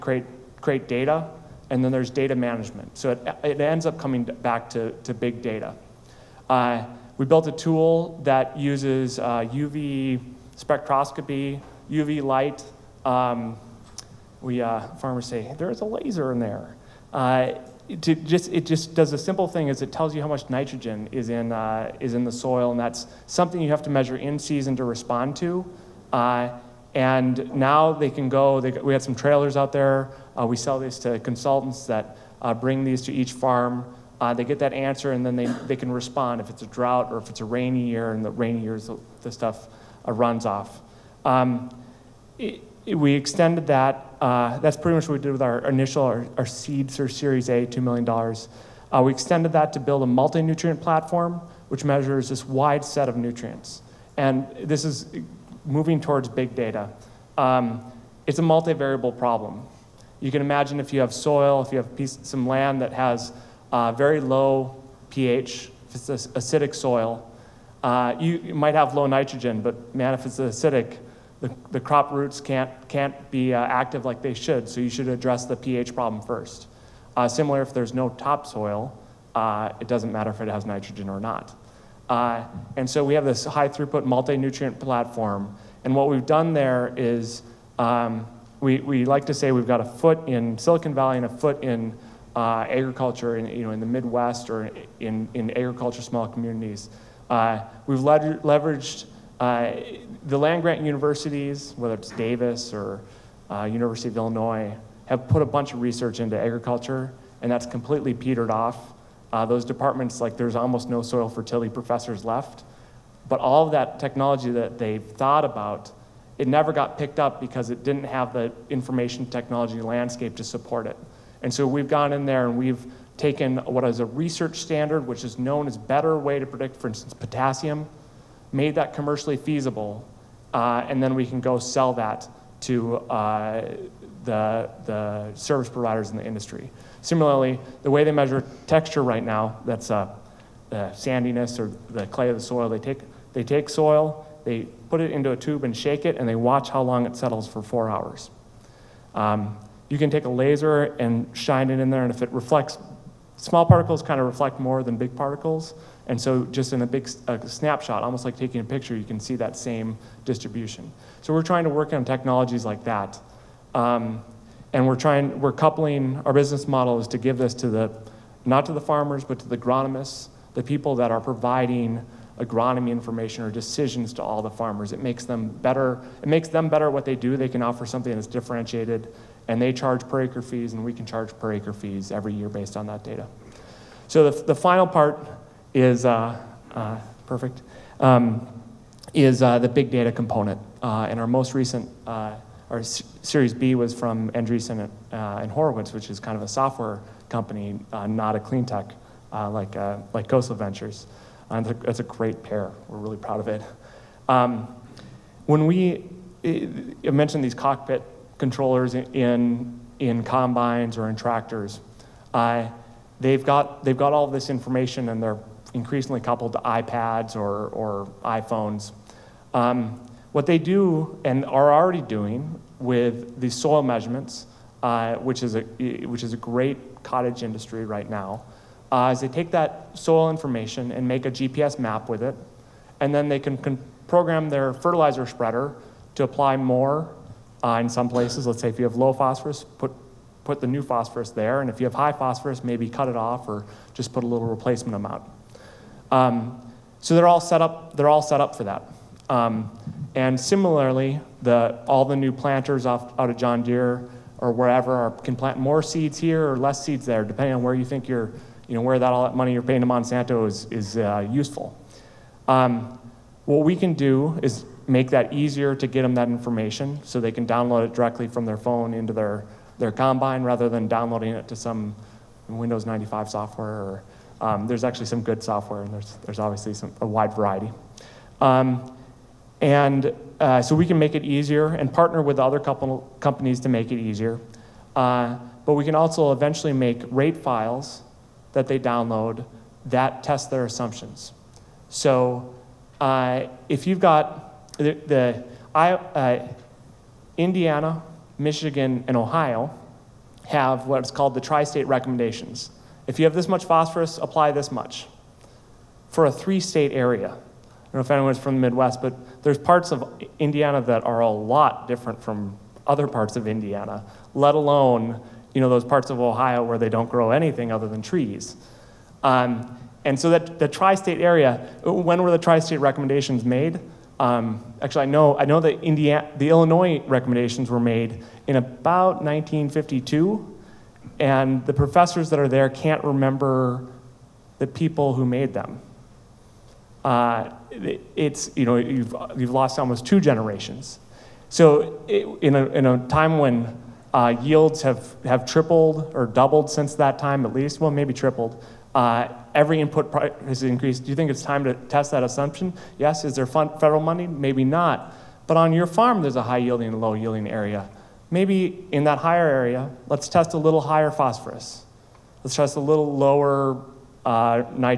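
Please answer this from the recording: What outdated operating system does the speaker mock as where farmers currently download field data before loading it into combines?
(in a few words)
Windows 95.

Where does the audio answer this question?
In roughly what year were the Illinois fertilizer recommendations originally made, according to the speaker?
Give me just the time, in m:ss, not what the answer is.
5:29.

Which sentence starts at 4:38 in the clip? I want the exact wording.
Um, and uh, so we can make it easier and partner with other couple, companies to make it easier.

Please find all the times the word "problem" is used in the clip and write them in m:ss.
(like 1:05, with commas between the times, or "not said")
0:59, 1:15.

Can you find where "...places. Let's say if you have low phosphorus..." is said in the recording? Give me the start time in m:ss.
3:58.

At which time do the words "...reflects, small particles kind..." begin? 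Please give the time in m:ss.
2:32.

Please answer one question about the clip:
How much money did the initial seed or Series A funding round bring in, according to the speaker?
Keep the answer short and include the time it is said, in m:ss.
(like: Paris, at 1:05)
$2 million, at 0:47.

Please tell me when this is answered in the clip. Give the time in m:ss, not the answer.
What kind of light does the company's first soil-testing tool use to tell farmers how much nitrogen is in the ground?
0:11.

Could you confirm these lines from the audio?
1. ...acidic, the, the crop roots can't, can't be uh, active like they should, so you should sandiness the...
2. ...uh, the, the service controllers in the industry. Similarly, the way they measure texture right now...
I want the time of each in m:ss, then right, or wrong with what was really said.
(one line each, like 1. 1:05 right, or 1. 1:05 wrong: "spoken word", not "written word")
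1. 1:10 wrong: "address", not "sandiness"
2. 2:12 wrong: "providers", not "controllers".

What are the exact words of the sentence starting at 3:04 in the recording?
So the, the final part is uh, uh, perfect.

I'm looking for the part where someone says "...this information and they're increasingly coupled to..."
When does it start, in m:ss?
3:34.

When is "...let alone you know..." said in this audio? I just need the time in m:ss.
5:14.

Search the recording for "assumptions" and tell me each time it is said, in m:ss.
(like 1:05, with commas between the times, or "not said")
4:50, 5:52.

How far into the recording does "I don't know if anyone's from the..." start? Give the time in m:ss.
5:07.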